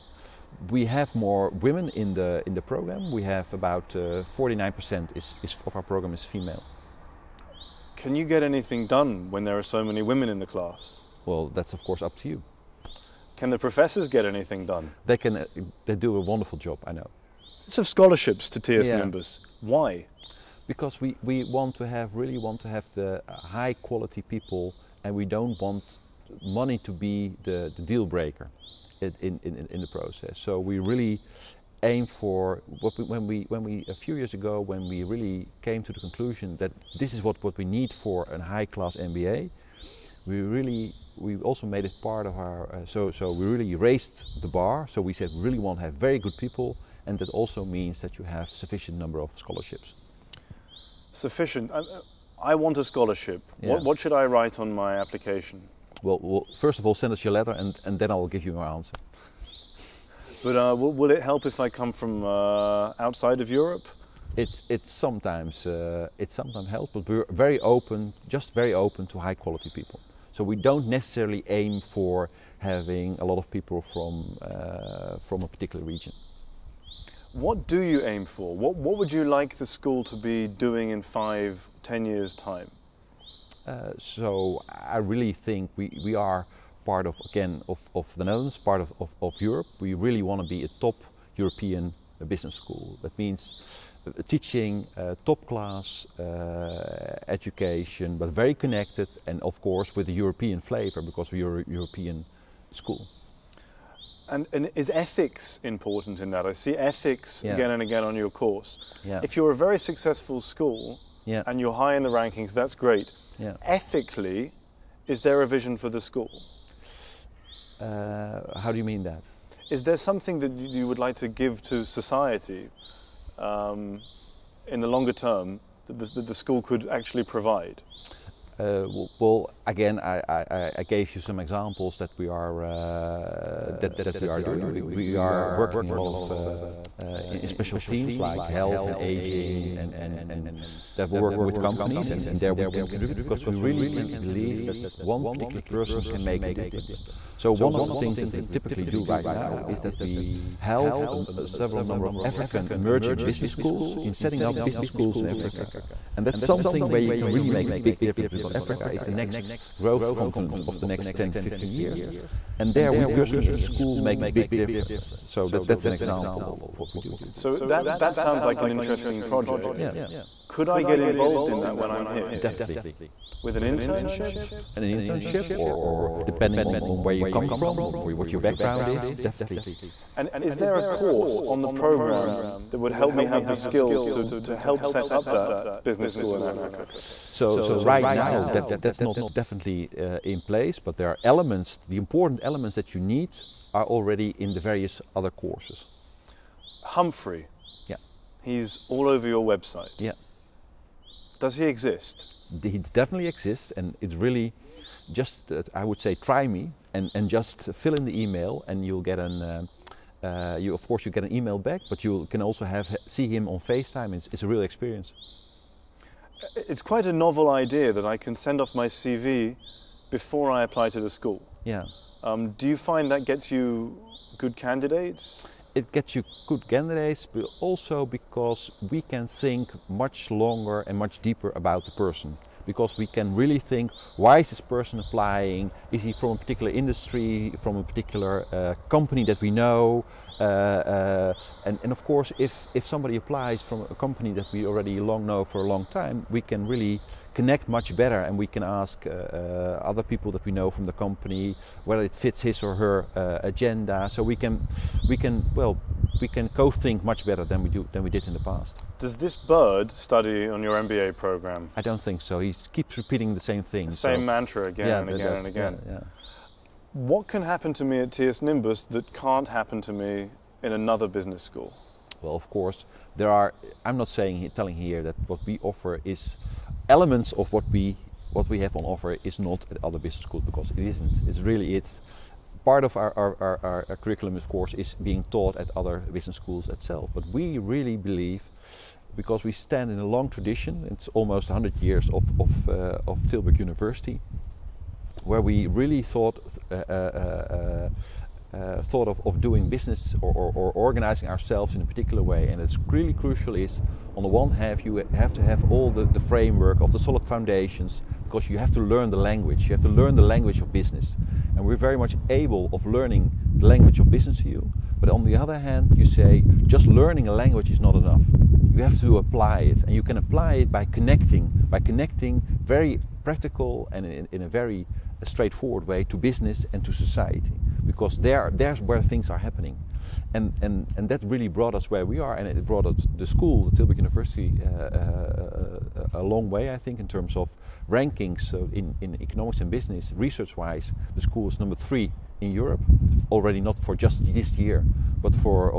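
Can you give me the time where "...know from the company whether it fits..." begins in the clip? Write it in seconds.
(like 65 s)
250 s.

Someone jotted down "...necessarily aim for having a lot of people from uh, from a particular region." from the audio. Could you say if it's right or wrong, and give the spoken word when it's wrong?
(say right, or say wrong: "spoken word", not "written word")
right.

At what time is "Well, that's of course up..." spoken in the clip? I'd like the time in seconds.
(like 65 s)
11 s.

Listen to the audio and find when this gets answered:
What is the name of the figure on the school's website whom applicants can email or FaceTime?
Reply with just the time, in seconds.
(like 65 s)
196 s.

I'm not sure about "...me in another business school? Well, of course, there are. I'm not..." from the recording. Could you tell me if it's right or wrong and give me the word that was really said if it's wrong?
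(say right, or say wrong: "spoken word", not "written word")
right.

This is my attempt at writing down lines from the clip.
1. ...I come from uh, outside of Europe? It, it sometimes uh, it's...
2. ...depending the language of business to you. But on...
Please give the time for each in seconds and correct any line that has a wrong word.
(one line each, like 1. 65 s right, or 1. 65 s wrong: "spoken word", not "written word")
1. 61 s right
2. 312 s wrong: "learning", not "depending".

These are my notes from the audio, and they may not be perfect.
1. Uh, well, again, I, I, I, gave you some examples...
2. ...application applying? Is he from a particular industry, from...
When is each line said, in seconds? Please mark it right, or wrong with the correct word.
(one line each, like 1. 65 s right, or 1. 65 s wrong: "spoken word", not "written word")
1. 128 s right
2. 234 s wrong: "person", not "application".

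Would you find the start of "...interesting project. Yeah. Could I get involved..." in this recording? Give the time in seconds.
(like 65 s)
168 s.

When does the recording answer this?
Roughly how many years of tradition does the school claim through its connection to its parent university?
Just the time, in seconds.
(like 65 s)
291 s.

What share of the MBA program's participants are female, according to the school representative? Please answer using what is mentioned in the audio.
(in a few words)
49%.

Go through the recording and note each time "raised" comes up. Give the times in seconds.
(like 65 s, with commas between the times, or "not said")
43 s.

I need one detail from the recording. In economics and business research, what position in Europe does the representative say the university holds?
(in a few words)
number 3.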